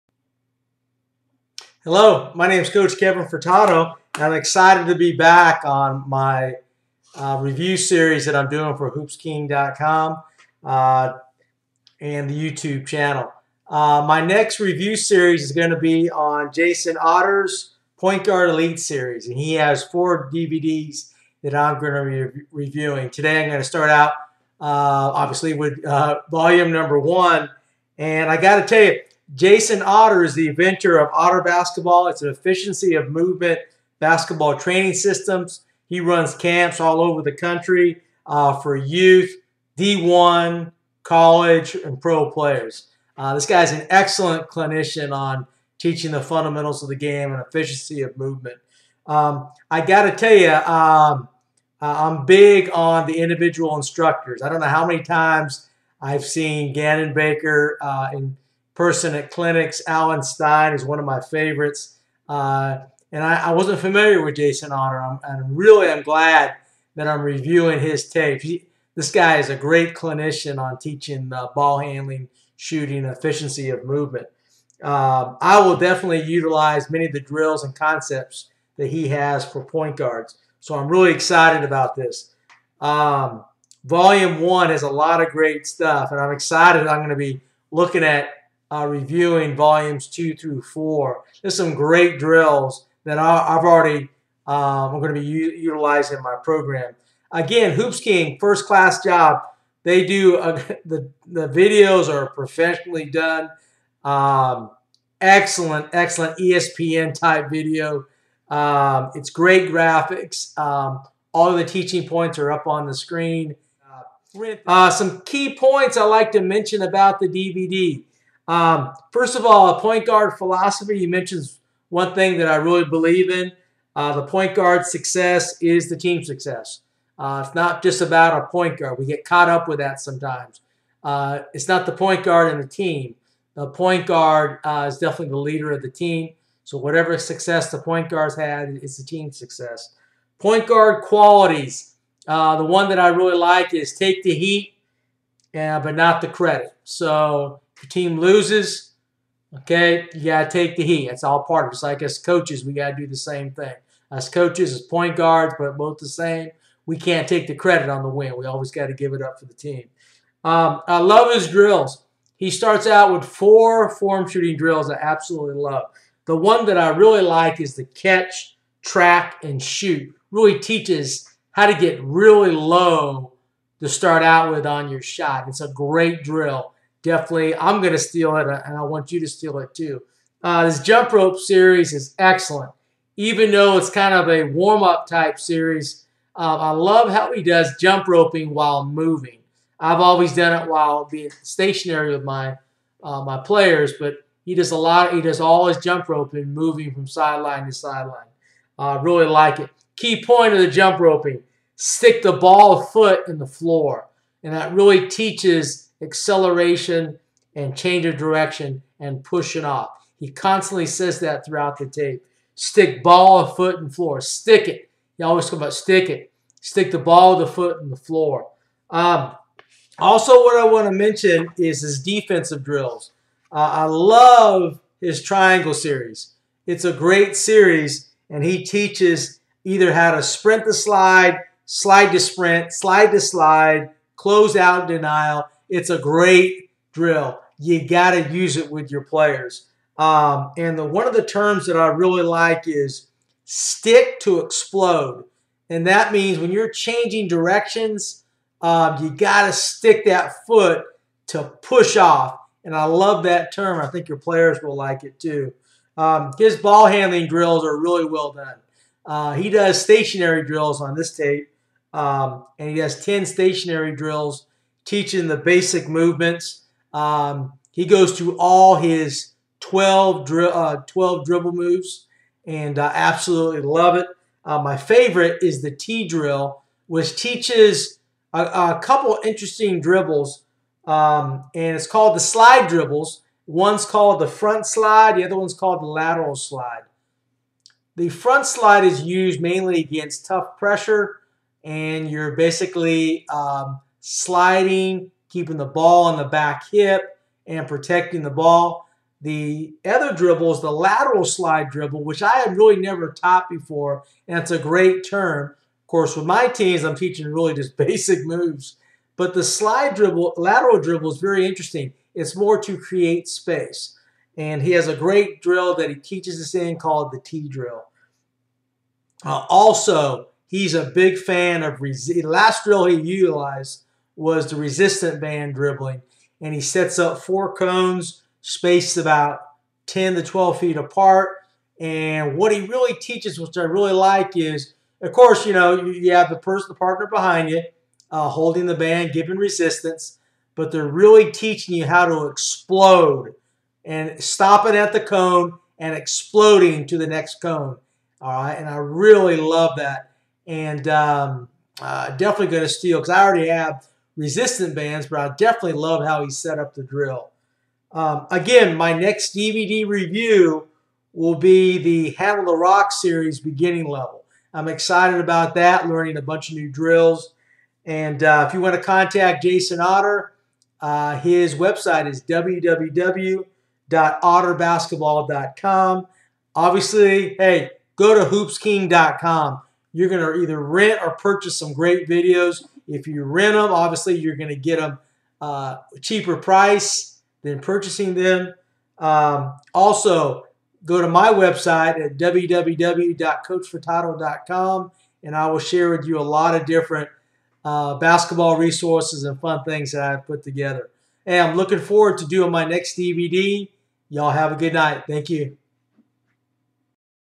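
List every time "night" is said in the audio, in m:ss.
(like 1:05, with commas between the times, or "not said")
6:44.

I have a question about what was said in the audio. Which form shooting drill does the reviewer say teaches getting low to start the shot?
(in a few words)
Catch, track, and shoot.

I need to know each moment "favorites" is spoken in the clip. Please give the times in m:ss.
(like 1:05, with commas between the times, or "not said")
1:01, 4:34.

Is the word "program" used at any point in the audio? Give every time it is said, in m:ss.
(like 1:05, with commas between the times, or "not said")
1:36.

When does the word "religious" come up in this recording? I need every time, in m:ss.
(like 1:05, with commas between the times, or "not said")
not said.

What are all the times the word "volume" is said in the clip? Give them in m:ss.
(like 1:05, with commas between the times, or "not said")
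0:26, 1:23, 1:29.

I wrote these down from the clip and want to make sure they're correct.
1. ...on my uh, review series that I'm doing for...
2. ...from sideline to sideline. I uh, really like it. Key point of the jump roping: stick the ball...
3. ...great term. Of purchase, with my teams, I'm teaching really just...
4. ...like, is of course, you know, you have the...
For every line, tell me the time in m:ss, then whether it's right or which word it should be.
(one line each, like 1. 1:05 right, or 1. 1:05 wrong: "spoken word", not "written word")
1. 0:05 right
2. 3:16 right
3. 5:04 wrong: "course", not "purchase"
4. 5:33 right.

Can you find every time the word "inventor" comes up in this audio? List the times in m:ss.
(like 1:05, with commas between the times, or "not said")
0:30.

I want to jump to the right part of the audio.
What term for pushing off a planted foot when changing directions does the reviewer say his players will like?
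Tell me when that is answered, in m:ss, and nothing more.
4:03.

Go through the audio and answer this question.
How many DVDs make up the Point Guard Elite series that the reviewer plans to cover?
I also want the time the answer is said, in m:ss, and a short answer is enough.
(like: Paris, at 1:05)
4, at 0:19.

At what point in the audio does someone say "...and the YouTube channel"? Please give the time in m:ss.
0:11.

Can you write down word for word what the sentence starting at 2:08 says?
We get caught up with that sometimes.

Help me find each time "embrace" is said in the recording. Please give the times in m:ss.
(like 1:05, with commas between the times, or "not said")
not said.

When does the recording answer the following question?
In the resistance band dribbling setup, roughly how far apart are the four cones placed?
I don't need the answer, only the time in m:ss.
5:29.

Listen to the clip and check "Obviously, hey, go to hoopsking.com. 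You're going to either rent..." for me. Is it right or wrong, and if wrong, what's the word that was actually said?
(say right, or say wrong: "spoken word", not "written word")
right.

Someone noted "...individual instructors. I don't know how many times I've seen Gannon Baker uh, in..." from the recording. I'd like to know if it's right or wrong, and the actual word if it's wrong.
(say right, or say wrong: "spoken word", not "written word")
right.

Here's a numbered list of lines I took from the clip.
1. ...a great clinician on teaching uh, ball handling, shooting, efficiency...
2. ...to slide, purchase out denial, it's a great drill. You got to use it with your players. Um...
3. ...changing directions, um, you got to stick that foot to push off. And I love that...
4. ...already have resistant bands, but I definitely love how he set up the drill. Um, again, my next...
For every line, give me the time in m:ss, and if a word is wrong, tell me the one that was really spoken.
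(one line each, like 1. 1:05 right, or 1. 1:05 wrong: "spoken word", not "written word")
1. 1:09 right
2. 3:53 wrong: "close", not "purchase"
3. 4:06 right
4. 5:53 right.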